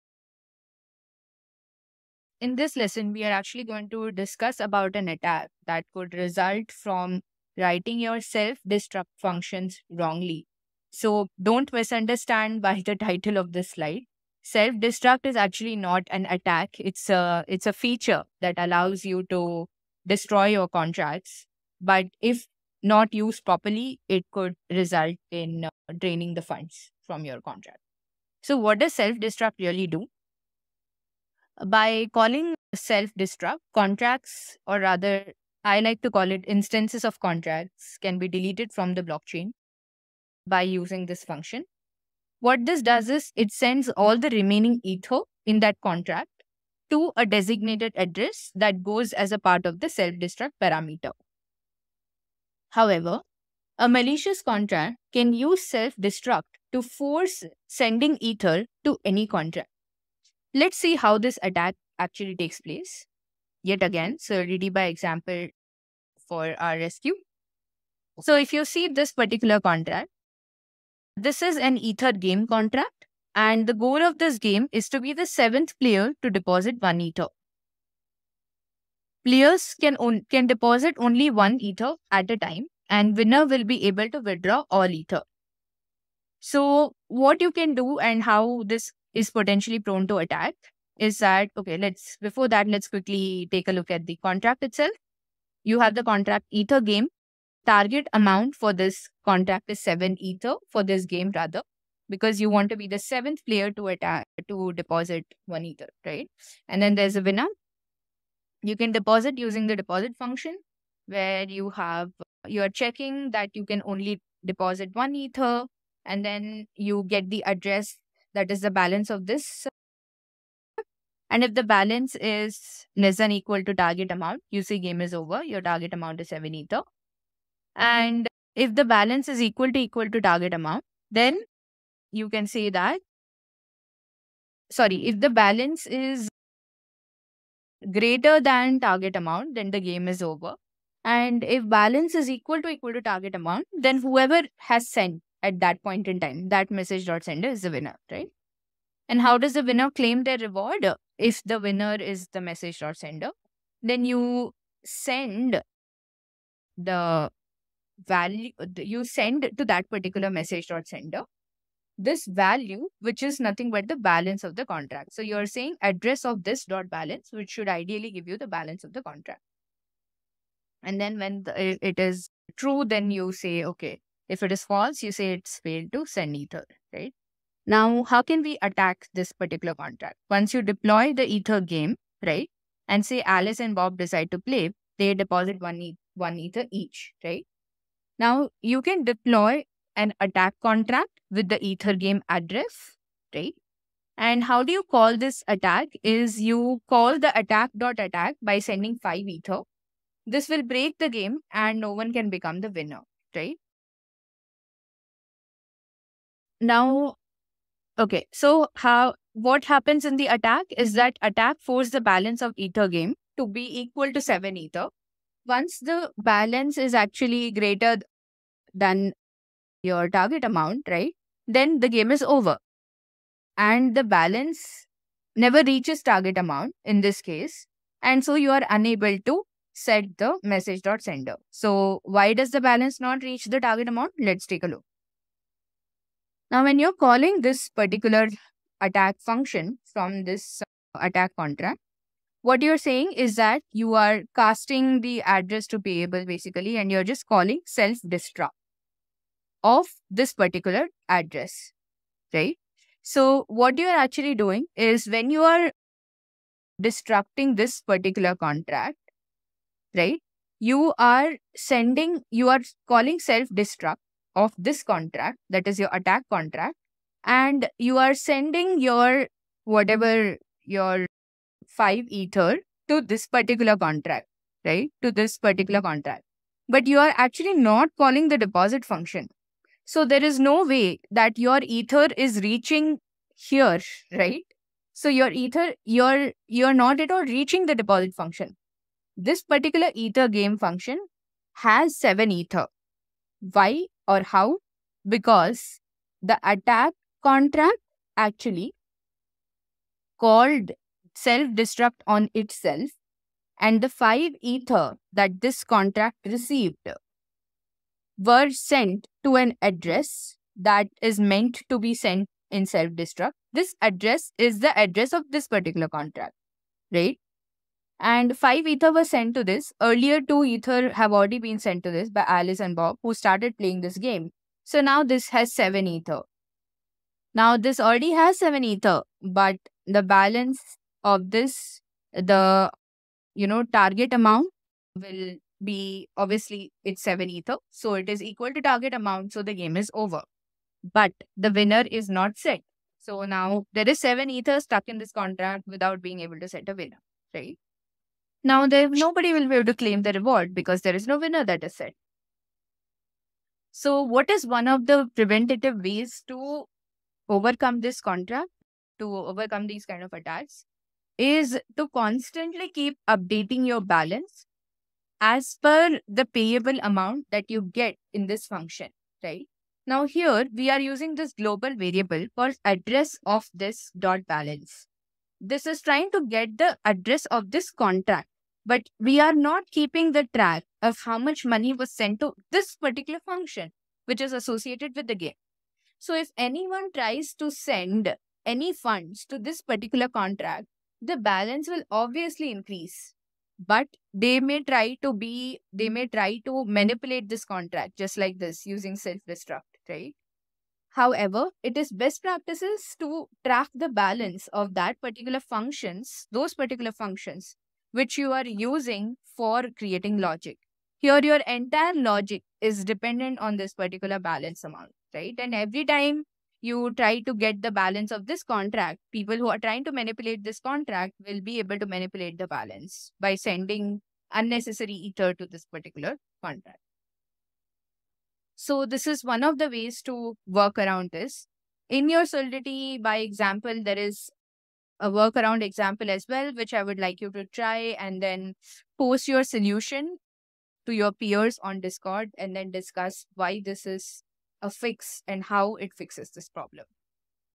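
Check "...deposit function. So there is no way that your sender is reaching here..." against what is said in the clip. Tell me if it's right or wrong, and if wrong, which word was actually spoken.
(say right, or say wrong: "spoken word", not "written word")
wrong: "ether", not "sender".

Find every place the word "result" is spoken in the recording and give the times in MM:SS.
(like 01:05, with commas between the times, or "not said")
00:06, 00:24.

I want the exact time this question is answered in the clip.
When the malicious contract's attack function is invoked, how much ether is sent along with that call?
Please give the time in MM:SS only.
03:19.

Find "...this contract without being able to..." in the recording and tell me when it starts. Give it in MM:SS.
05:44.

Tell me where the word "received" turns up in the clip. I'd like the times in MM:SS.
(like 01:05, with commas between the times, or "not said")
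05:06.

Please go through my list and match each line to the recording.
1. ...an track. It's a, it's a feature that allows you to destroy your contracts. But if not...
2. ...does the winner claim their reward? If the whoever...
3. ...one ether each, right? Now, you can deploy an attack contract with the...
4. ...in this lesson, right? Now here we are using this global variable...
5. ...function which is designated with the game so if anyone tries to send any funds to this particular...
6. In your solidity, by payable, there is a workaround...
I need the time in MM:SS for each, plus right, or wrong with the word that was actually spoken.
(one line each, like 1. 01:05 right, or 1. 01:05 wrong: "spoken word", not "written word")
1. 00:16 wrong: "attack", not "track"
2. 02:29 wrong: "winner", not "whoever"
3. 03:06 right
4. 06:08 wrong: "function", not "lesson"
5. 06:23 wrong: "associated", not "designated"
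6. 07:11 wrong: "example", not "payable".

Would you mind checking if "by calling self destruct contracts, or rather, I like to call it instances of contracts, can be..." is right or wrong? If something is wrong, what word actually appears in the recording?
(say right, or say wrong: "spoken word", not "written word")
right.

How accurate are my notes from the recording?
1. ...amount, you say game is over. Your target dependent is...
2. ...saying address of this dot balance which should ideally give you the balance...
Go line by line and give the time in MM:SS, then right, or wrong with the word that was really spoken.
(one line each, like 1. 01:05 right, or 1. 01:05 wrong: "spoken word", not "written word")
1. 02:04 wrong: "amount", not "dependent"
2. 02:45 right.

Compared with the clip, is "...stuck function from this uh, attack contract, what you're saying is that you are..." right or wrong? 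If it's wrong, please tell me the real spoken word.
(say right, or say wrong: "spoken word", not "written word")
wrong: "attack", not "stuck".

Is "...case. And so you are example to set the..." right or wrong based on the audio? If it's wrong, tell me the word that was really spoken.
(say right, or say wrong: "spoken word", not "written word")
wrong: "unable", not "example".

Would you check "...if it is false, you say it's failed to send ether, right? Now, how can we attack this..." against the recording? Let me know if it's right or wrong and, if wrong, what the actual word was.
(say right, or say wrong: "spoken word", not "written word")
right.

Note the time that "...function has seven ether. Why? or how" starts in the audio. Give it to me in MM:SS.
04:50.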